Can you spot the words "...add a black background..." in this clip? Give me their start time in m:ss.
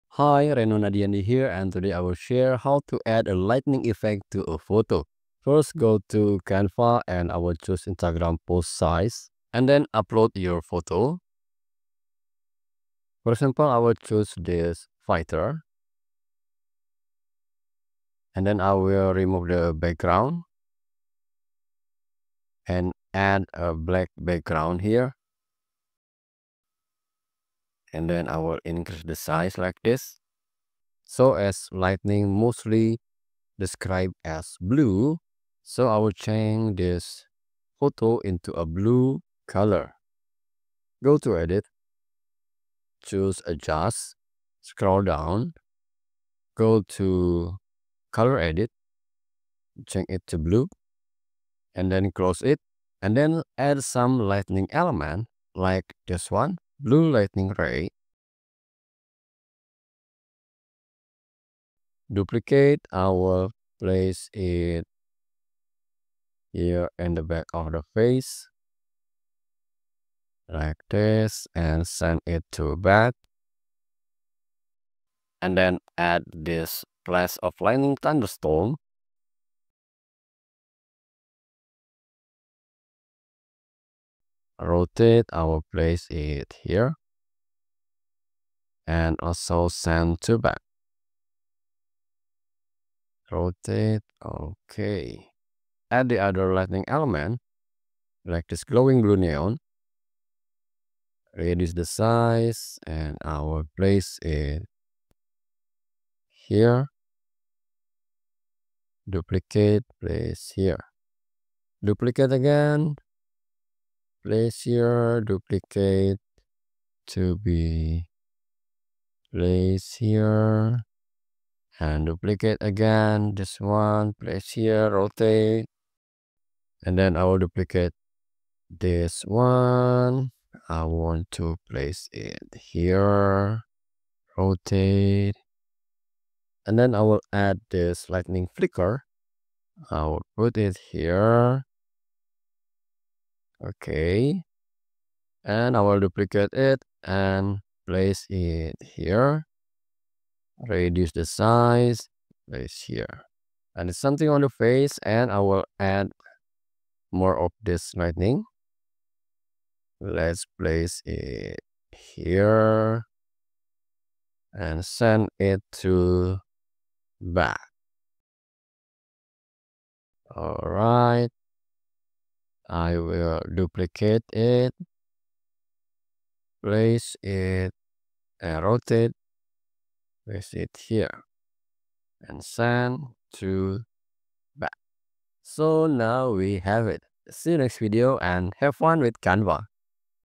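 0:23.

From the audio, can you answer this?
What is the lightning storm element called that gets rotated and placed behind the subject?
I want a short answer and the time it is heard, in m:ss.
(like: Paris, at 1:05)
Flash of lightning thunderstorm, at 1:17.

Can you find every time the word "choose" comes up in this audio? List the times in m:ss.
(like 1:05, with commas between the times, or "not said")
0:07, 0:13, 0:43.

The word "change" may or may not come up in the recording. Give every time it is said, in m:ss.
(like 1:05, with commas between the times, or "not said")
0:36, 0:49.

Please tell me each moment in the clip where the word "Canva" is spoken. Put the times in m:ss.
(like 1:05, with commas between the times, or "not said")
0:06, 3:09.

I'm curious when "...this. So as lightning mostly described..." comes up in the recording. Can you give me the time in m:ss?
0:29.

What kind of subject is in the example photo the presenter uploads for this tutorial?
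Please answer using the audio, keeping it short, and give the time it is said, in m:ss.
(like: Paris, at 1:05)
Fighter, at 0:15.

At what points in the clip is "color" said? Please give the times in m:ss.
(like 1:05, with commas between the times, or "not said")
0:39, 0:48.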